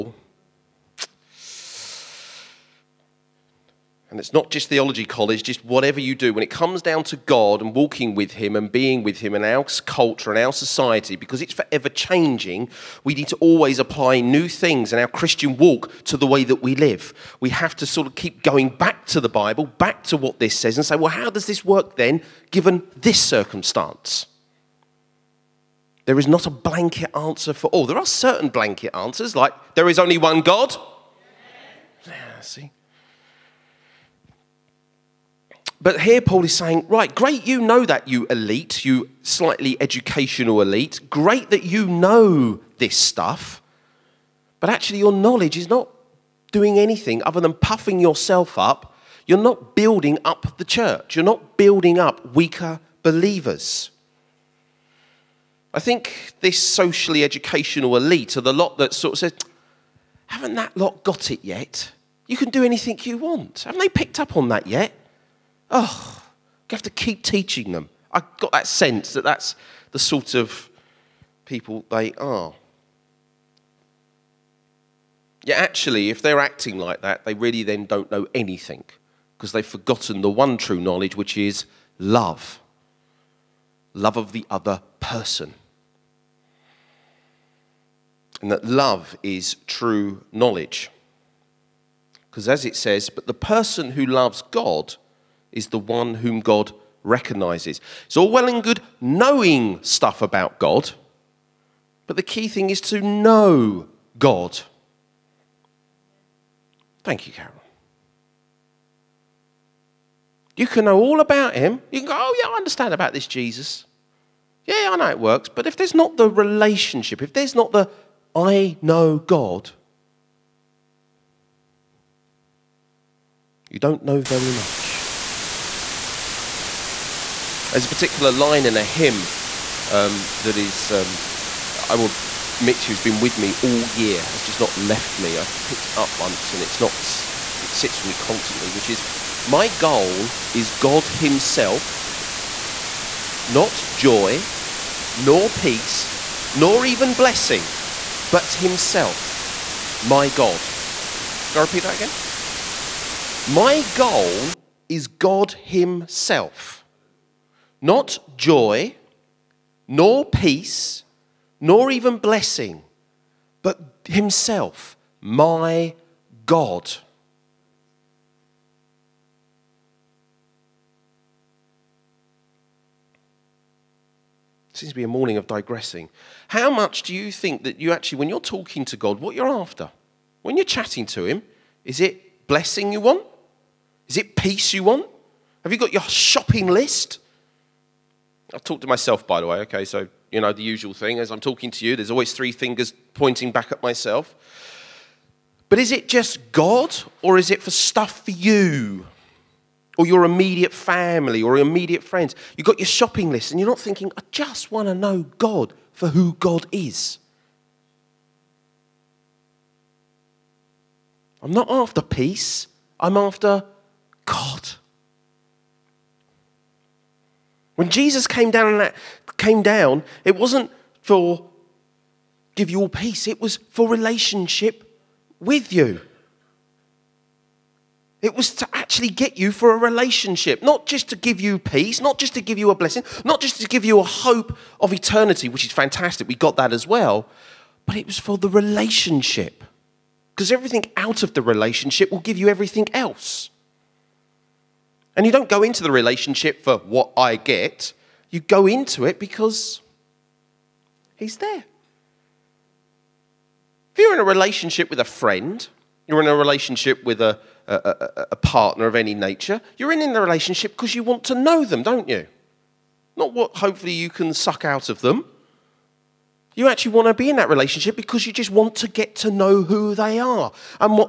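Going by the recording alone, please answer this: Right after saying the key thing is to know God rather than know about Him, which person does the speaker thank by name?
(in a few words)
Carol.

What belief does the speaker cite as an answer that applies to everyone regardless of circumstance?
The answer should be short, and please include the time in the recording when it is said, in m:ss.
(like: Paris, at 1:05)
There is only one God, at 0:29.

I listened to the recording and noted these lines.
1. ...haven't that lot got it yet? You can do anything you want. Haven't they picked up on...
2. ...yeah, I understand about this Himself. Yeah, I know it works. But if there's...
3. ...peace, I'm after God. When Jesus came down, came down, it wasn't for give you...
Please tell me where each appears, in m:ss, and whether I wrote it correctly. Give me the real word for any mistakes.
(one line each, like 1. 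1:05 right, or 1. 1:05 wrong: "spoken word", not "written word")
1. 1:00 right
2. 1:52 wrong: "Jesus", not "Himself"
3. 3:32 right.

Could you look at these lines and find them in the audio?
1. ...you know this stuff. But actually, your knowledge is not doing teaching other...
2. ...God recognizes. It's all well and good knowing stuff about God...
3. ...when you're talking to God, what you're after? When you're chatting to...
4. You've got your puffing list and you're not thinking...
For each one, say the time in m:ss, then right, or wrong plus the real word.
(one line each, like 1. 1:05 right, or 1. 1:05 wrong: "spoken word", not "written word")
1. 0:41 wrong: "anything", not "teaching"
2. 1:36 right
3. 2:58 right
4. 3:22 wrong: "shopping", not "puffing".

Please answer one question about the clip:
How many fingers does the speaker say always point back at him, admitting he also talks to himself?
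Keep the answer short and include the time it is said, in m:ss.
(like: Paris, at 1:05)
3, at 3:12.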